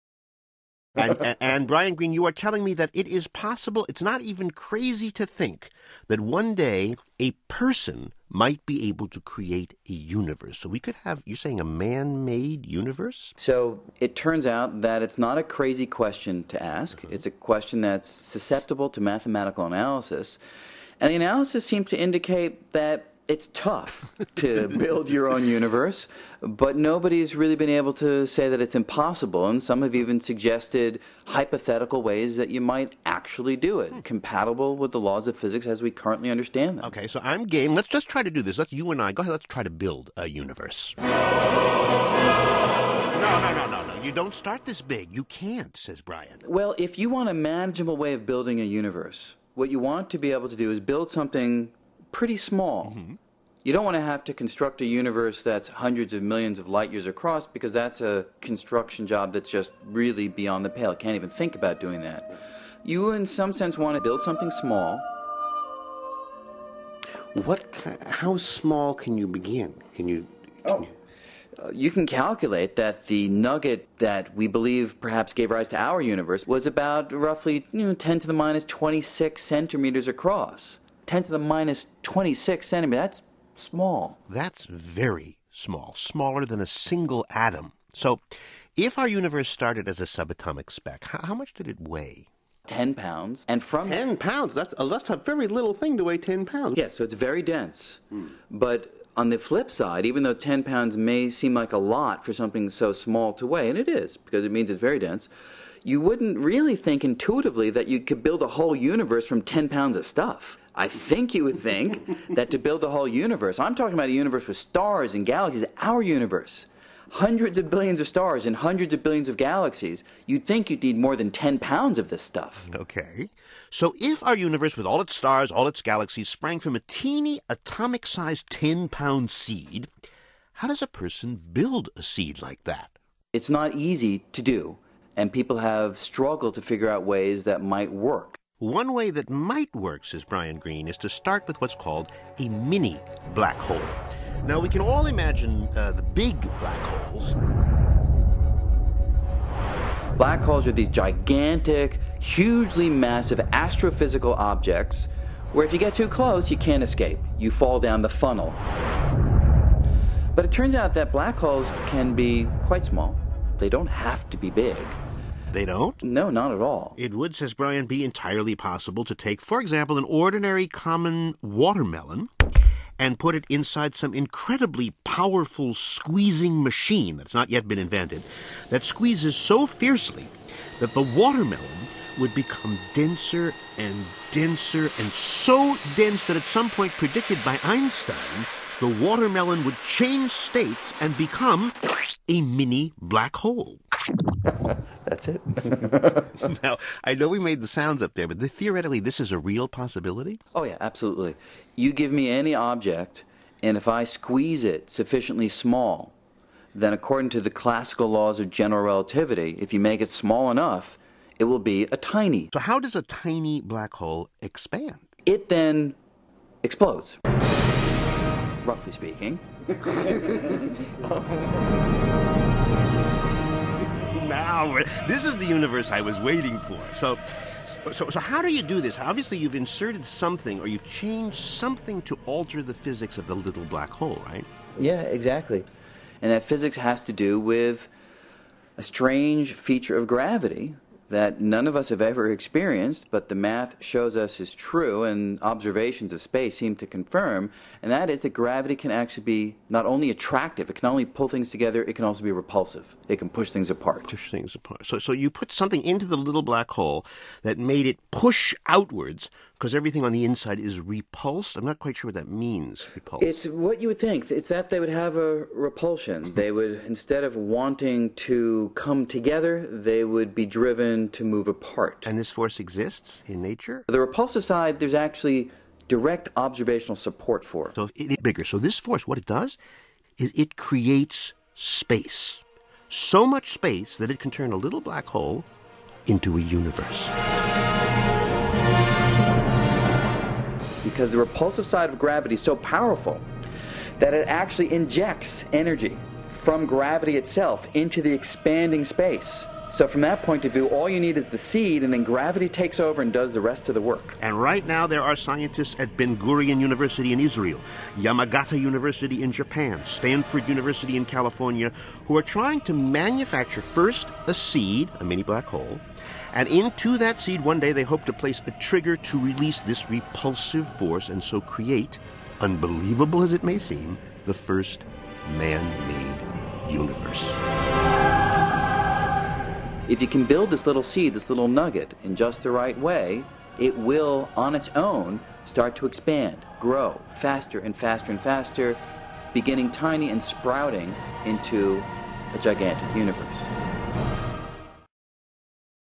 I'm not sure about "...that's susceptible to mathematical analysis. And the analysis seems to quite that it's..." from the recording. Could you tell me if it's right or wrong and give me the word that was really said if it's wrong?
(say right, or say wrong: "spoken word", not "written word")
wrong: "indicate", not "quite".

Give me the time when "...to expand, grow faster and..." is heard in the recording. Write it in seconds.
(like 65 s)
335 s.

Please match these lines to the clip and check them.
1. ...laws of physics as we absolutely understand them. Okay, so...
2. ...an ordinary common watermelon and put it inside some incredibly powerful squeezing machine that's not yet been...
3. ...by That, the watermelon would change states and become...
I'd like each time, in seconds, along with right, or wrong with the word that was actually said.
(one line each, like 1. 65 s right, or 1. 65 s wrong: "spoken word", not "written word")
1. 34 s wrong: "currently", not "absolutely"
2. 169 s right
3. 187 s wrong: "Einstein", not "That".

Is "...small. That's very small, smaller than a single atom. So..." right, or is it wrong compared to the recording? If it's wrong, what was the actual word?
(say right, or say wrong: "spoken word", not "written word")
right.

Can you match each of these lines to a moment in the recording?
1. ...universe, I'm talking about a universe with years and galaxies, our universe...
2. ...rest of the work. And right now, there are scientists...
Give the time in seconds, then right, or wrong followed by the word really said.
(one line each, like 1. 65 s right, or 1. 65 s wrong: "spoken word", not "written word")
1. 113 s wrong: "stars", not "years"
2. 303 s right.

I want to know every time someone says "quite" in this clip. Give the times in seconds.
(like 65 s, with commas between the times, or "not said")
162 s, 261 s.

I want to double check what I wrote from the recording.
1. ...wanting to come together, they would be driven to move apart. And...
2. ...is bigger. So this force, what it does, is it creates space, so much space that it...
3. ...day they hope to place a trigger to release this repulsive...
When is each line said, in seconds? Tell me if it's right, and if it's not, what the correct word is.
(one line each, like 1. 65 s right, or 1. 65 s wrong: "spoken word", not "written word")
1. 267 s right
2. 278 s right
3. 317 s right.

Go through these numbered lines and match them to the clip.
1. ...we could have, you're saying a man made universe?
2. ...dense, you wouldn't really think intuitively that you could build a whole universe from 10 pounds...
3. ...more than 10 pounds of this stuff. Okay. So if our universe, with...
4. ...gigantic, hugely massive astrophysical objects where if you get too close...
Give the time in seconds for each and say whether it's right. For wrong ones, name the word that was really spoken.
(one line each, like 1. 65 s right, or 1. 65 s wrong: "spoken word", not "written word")
1. 10 s right
2. 104 s right
3. 120 s right
4. 150 s right.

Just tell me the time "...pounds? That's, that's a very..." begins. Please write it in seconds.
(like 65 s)
94 s.